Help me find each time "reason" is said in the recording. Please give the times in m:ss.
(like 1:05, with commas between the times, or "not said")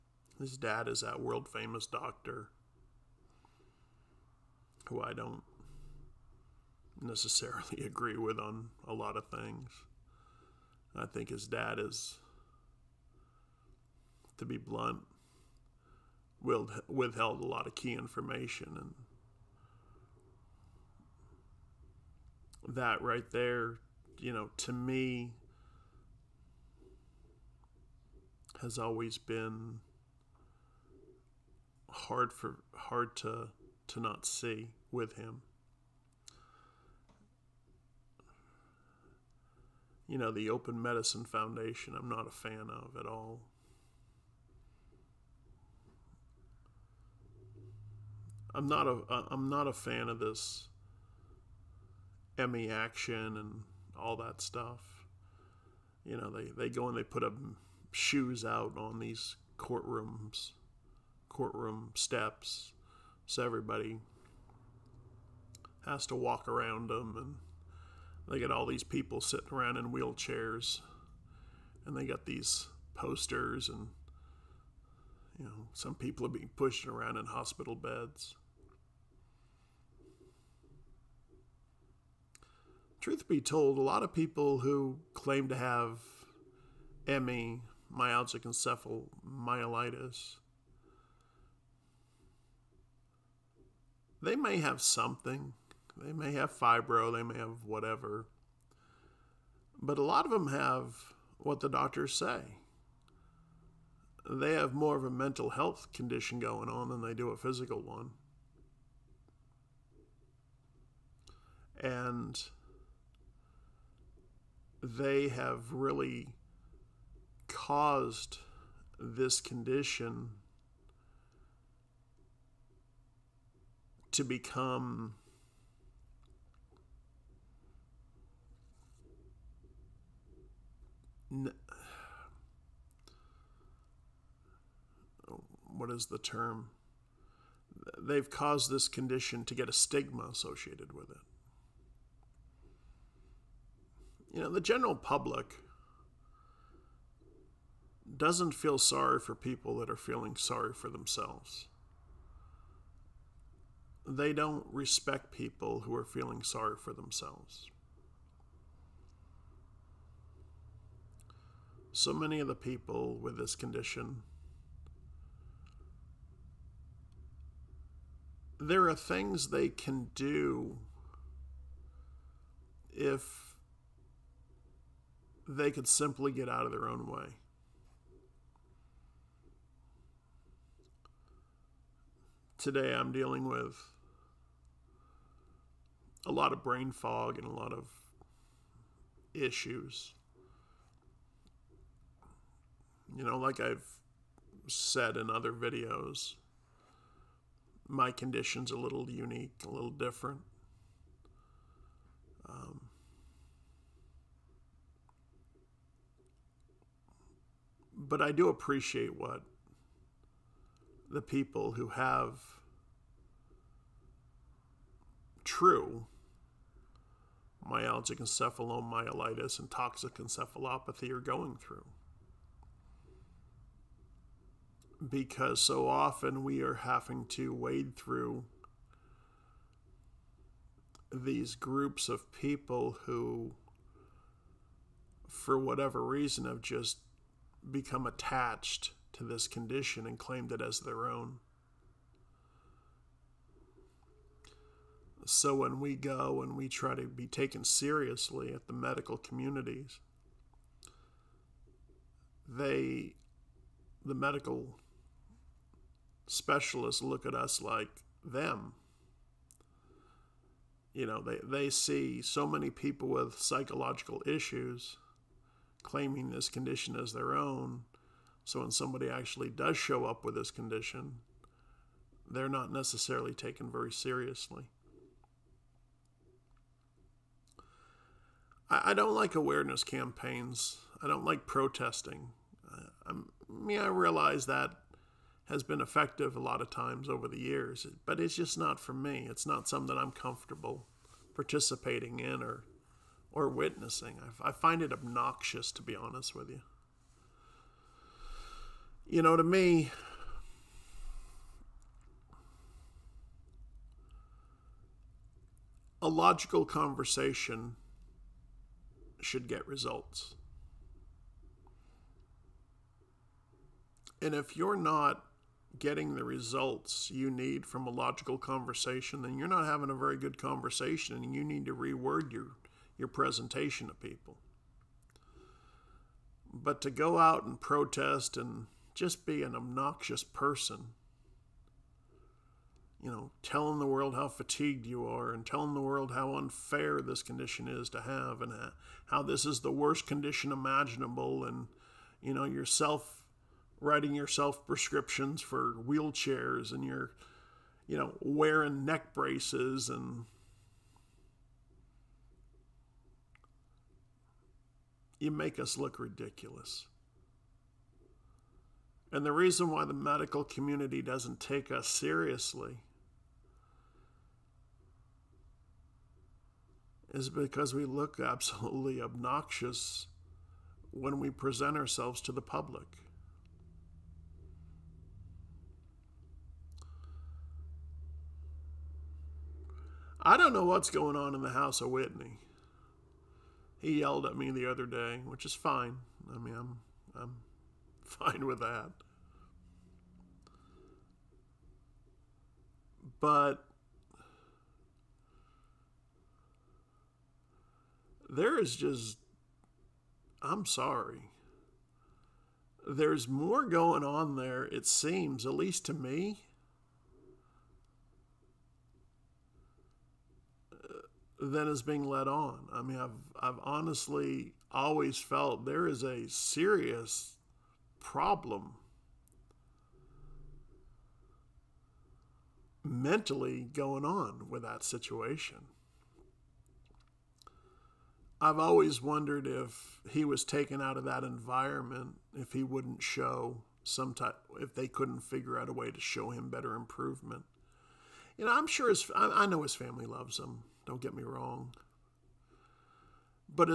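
3:56, 5:59.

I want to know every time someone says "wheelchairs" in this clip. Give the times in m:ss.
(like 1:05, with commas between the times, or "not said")
1:09, 5:45.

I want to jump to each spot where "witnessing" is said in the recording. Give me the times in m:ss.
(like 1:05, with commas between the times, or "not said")
4:53.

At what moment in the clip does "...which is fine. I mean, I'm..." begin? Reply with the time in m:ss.
6:25.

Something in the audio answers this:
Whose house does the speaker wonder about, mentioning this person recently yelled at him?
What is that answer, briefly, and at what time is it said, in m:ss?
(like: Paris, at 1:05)
Whitney, at 6:21.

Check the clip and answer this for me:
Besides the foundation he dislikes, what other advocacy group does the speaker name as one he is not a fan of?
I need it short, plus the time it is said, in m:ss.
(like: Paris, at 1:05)
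MEAction, at 0:52.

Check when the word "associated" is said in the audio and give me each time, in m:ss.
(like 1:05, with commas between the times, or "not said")
2:20.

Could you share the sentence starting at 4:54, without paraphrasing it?
I, I find it obnoxious, to be honest with you you know, to me, a logical conversation should get results.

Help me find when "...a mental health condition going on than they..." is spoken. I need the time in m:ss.
1:45.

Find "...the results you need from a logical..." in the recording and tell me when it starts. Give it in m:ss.
5:16.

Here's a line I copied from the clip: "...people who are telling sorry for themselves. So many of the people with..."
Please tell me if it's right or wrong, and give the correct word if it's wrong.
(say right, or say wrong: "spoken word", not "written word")
wrong: "feeling", not "telling".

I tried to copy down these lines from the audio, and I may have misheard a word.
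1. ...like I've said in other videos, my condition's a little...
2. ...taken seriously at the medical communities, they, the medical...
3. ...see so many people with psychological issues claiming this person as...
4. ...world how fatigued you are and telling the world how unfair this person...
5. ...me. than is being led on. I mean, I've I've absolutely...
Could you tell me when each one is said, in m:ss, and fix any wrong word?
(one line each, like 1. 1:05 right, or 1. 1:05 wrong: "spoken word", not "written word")
1. 3:13 right
2. 4:07 right
3. 4:21 wrong: "condition", not "person"
4. 5:33 wrong: "condition", not "person"
5. 6:45 wrong: "honestly", not "absolutely".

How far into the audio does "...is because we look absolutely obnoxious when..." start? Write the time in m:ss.
6:07.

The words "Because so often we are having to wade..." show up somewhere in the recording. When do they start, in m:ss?
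3:45.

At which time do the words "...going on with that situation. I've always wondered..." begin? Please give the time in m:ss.
7:03.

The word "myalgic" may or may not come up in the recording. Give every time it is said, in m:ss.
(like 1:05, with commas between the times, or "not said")
1:27, 3:37.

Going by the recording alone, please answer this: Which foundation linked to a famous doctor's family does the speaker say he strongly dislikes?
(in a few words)
Open Medicine Foundation.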